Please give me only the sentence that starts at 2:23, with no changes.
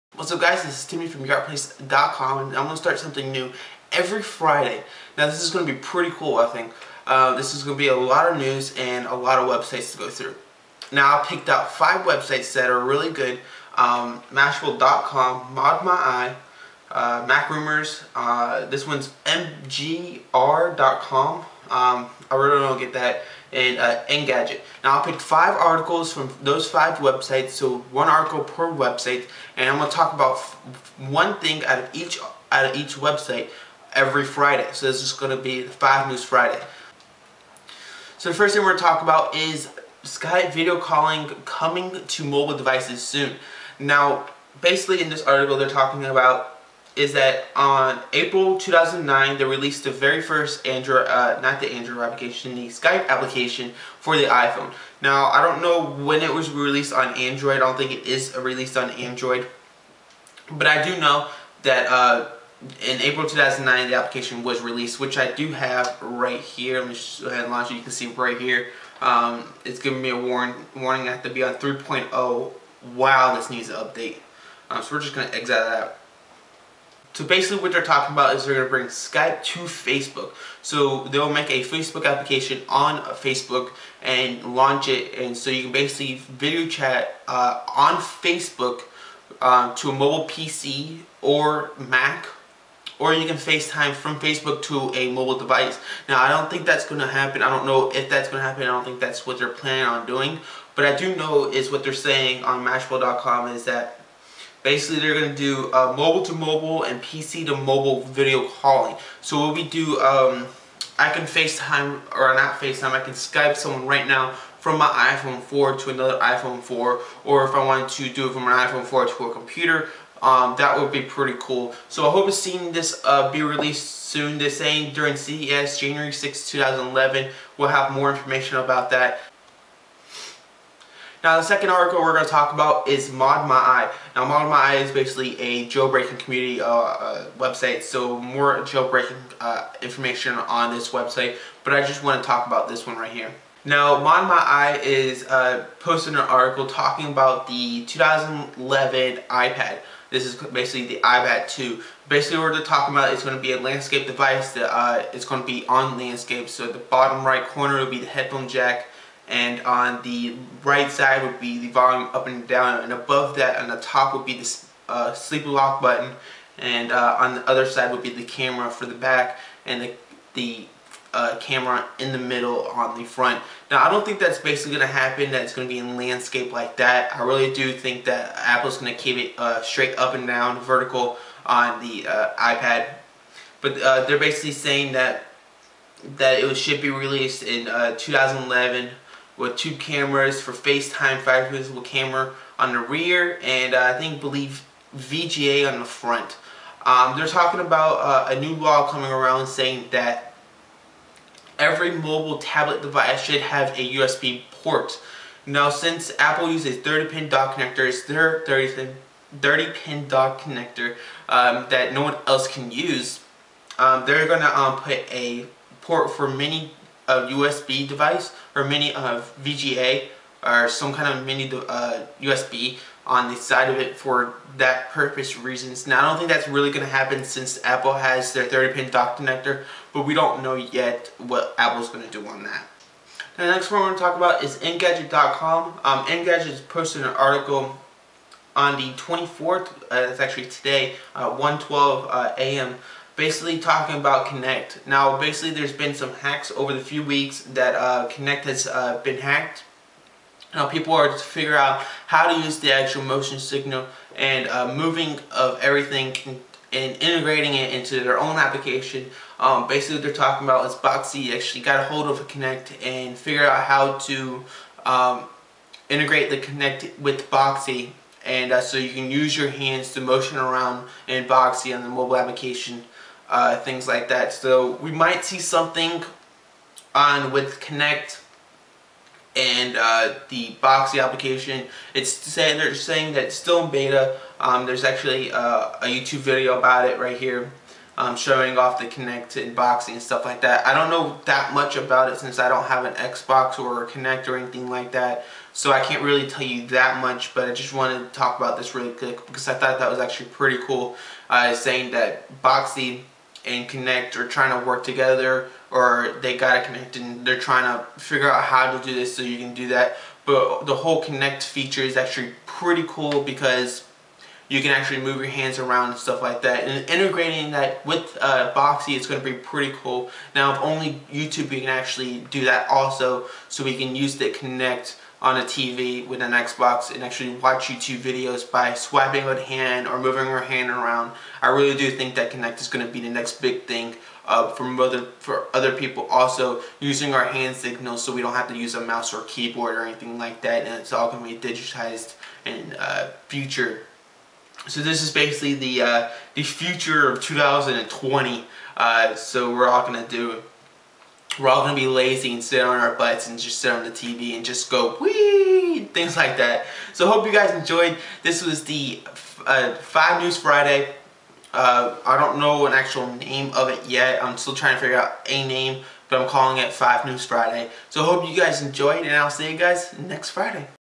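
Now ModMyi is uh, posting an article talking about the 2011 iPad.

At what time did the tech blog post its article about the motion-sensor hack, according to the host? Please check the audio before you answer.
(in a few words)
1:12 a.m.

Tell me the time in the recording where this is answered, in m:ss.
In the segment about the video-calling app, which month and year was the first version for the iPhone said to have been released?
0:47.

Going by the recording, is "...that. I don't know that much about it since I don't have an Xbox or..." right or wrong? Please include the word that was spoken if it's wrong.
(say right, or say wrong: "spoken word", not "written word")
right.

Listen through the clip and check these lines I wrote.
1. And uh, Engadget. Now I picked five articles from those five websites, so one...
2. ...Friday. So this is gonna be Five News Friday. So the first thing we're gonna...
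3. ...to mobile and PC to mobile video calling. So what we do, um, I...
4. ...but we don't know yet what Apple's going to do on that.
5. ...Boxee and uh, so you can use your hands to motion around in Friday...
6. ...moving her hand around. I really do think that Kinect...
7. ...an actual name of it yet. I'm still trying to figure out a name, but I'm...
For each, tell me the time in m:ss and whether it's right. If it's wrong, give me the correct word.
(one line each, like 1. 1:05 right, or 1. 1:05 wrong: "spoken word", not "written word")
1. 0:23 right
2. 0:34 right
3. 1:46 right
4. 3:49 right
5. 4:27 wrong: "Boxee", not "Friday"
6. 5:29 right
7. 6:02 right.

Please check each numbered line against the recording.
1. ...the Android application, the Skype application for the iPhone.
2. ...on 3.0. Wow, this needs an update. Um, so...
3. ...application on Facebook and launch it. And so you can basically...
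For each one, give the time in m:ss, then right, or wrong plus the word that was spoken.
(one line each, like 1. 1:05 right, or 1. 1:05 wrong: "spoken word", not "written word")
1. 0:51 right
2. 1:11 right
3. 1:22 right.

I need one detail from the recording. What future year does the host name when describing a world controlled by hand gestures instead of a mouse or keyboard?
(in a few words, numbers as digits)
2020.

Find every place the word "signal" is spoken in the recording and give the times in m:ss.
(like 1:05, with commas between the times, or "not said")
4:13, 5:37.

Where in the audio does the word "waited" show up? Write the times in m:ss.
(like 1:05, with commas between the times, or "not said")
not said.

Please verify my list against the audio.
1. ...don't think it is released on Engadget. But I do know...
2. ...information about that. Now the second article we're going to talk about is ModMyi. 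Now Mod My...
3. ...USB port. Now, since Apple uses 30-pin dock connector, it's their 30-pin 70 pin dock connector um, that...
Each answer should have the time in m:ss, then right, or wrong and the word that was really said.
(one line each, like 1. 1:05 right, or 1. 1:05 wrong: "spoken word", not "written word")
1. 0:57 wrong: "Android", not "Engadget"
2. 2:08 right
3. 3:23 wrong: "30", not "70".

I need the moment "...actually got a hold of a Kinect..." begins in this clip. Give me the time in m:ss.
4:21.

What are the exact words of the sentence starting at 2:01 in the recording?
So I hope to see this uh, be released soon.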